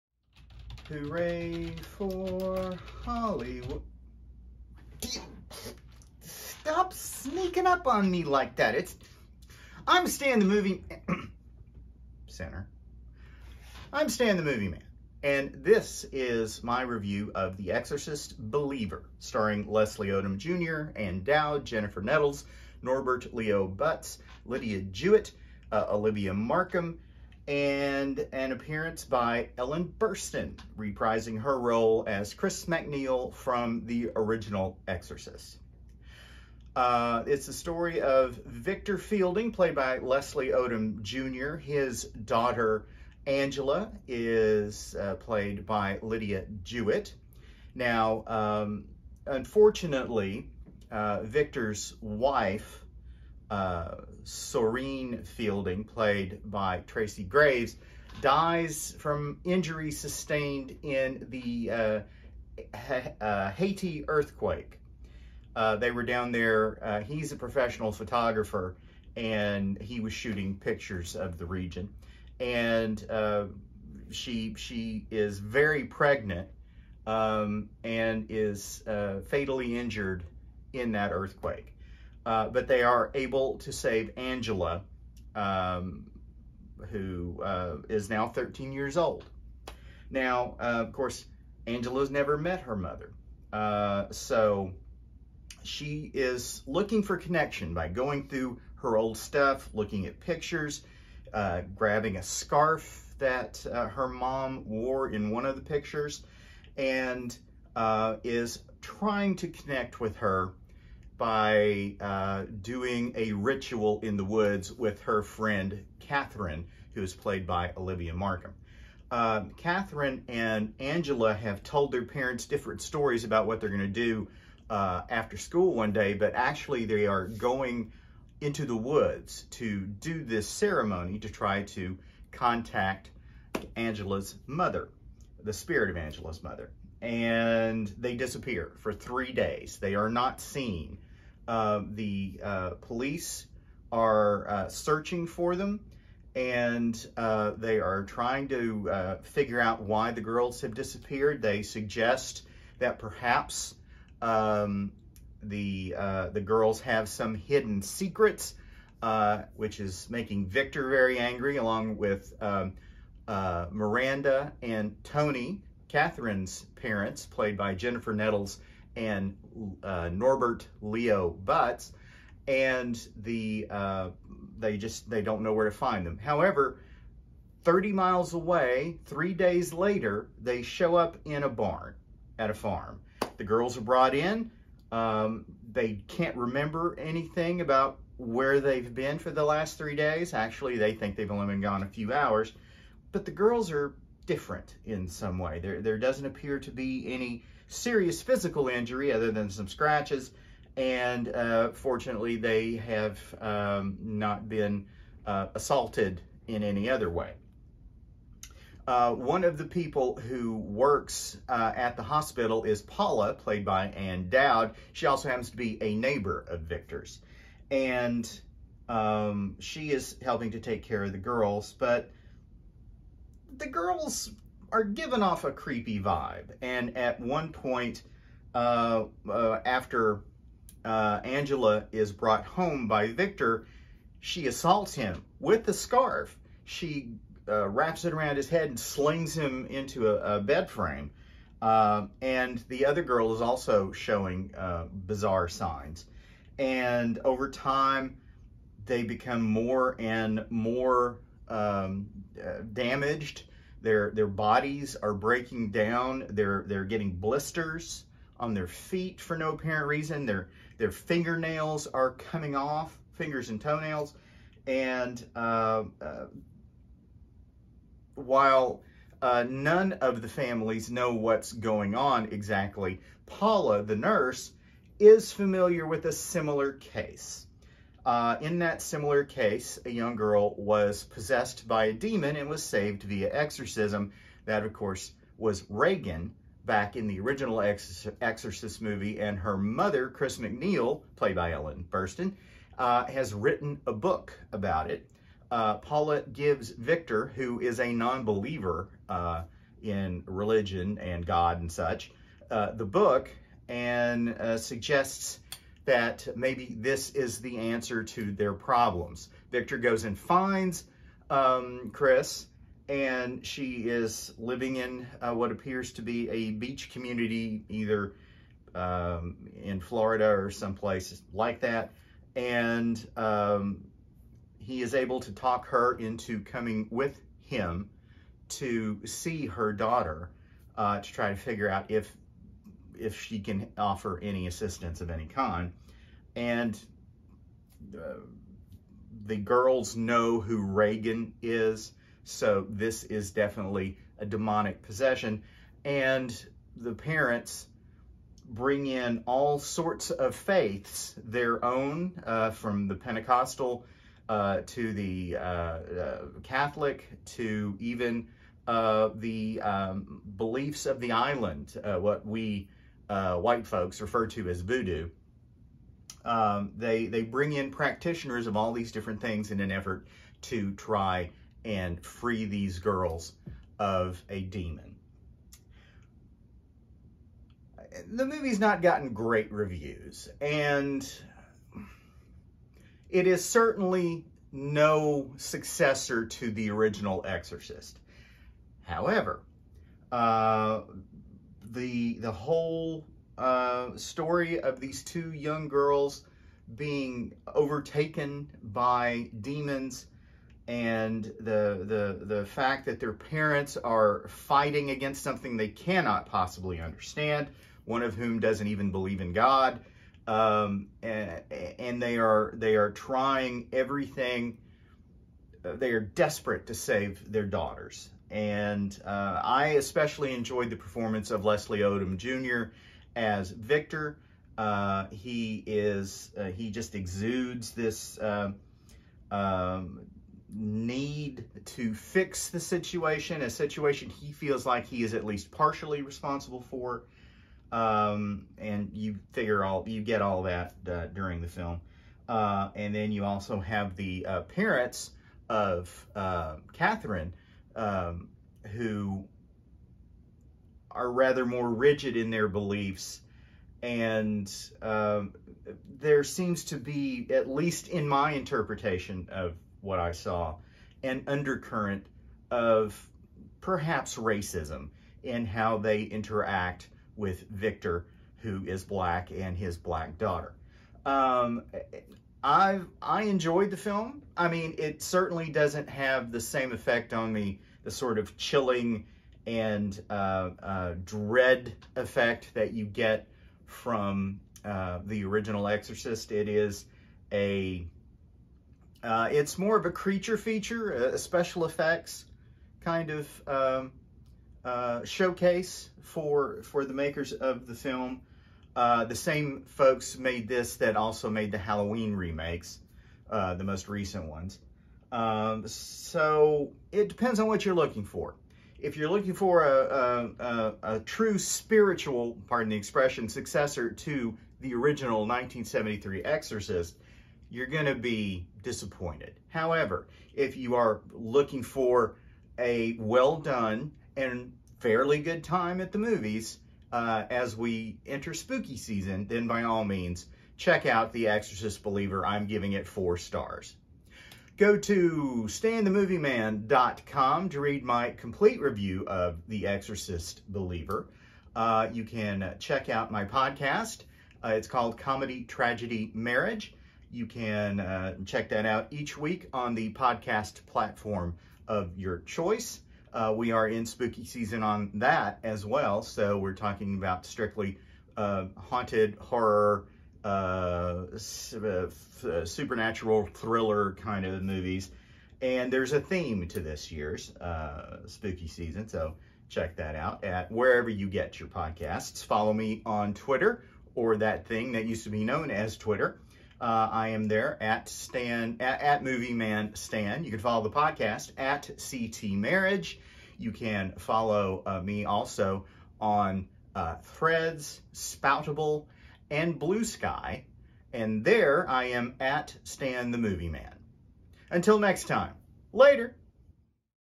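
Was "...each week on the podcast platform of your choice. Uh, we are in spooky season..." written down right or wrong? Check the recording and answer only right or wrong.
right.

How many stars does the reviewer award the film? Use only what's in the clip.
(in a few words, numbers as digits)
4.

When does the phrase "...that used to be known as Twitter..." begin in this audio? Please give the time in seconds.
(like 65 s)
574 s.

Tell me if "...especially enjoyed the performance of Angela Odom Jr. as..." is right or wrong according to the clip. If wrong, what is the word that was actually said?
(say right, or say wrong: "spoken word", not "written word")
wrong: "Leslie", not "Angela".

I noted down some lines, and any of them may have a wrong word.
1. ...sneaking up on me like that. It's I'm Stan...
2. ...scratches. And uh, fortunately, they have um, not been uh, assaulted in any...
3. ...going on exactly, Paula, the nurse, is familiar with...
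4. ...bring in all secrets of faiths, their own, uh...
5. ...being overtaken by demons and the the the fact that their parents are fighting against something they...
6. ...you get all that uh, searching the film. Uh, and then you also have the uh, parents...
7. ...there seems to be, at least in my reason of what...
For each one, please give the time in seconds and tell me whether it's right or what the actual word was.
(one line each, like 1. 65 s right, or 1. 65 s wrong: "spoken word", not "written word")
1. 6 s right
2. 199 s right
3. 271 s right
4. 348 s wrong: "sorts", not "secrets"
5. 396 s right
6. 439 s wrong: "during", not "searching"
7. 455 s wrong: "interpretation", not "reason".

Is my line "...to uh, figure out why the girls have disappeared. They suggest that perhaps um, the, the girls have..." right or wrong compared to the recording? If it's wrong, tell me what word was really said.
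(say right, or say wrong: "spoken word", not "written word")
right.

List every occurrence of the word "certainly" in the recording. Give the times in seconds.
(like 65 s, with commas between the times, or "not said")
383 s, 475 s.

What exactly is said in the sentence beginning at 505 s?
Um, so it depends on what you're looking for.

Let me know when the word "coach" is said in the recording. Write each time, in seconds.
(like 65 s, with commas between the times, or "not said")
not said.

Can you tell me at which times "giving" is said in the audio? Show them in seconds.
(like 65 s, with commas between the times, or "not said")
224 s, 532 s.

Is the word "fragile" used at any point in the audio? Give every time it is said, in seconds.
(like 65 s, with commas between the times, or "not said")
not said.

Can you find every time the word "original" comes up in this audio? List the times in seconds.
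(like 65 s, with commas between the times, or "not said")
34 s, 287 s, 386 s, 485 s, 514 s.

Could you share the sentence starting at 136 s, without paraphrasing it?
And they disappear for three days.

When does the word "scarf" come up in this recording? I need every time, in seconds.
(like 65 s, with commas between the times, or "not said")
102 s, 235 s.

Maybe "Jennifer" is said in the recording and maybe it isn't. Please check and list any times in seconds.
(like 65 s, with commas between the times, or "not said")
21 s, 167 s.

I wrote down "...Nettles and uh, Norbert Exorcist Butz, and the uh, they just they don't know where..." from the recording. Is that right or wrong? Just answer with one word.
wrong.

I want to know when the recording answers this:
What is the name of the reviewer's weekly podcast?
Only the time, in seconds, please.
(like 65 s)
544 s.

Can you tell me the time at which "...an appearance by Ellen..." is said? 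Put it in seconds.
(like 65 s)
28 s.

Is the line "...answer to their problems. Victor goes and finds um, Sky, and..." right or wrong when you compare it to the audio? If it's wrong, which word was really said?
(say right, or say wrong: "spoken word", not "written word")
wrong: "Chris", not "Sky".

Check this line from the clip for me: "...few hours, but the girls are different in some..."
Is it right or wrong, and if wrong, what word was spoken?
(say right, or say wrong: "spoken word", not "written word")
right.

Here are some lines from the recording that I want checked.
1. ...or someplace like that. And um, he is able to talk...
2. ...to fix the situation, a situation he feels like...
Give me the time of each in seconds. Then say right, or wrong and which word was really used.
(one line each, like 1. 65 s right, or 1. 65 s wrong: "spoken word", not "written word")
1. 320 s right
2. 431 s right.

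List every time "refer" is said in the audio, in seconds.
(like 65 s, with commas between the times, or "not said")
363 s.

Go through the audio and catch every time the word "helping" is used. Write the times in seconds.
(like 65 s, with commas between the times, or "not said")
220 s.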